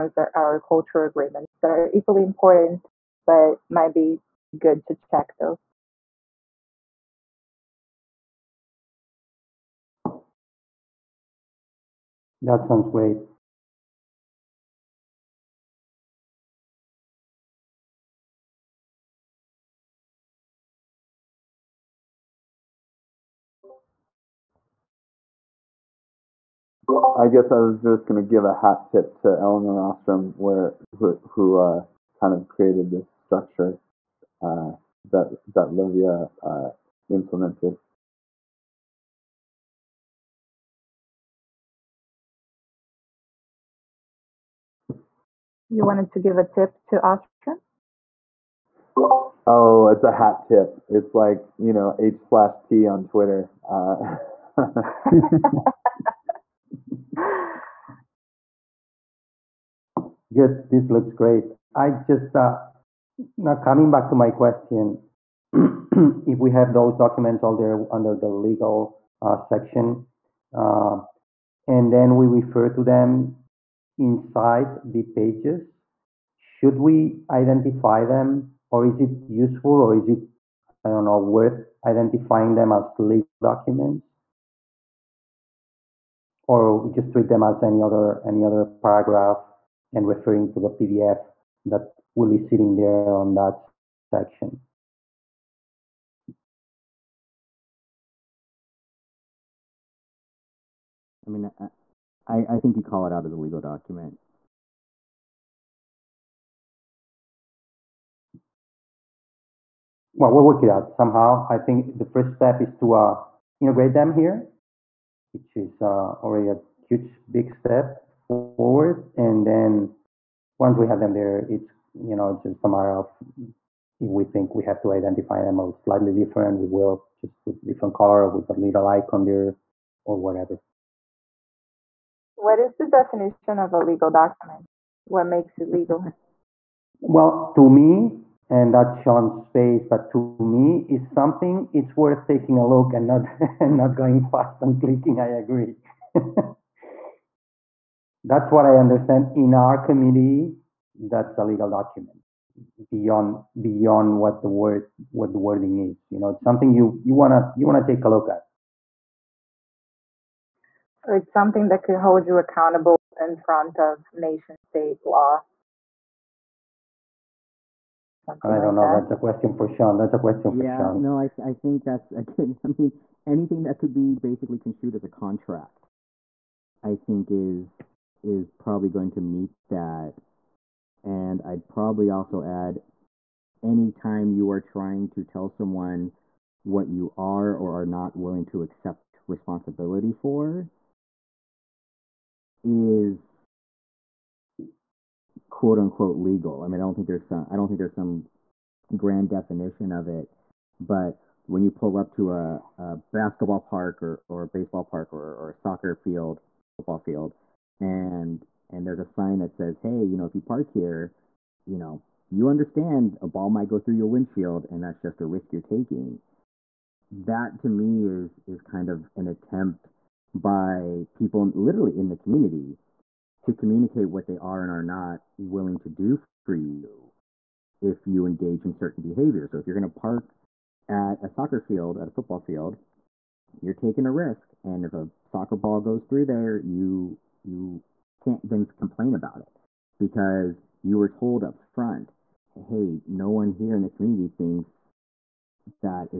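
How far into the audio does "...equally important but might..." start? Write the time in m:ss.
0:01.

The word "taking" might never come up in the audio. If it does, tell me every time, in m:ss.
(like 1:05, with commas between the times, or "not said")
2:22, 3:35, 3:53.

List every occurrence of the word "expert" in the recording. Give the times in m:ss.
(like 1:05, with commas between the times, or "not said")
not said.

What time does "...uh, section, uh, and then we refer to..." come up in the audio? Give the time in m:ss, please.
1:09.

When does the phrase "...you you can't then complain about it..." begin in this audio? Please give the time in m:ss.
3:56.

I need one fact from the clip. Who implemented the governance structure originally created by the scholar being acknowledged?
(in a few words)
Livia.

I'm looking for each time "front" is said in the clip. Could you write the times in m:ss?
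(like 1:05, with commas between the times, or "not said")
2:43, 4:01.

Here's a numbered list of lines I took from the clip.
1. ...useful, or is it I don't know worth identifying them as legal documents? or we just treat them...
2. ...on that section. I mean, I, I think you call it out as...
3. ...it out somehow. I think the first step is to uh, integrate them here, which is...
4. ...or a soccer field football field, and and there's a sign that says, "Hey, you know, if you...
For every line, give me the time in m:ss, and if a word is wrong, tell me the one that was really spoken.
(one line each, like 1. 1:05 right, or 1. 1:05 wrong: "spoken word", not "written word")
1. 1:19 right
2. 1:33 right
3. 1:50 right
4. 3:25 right.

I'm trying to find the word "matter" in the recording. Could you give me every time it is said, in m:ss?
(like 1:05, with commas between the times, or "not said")
2:02.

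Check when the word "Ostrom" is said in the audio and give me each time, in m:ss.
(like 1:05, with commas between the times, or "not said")
0:29, 0:47.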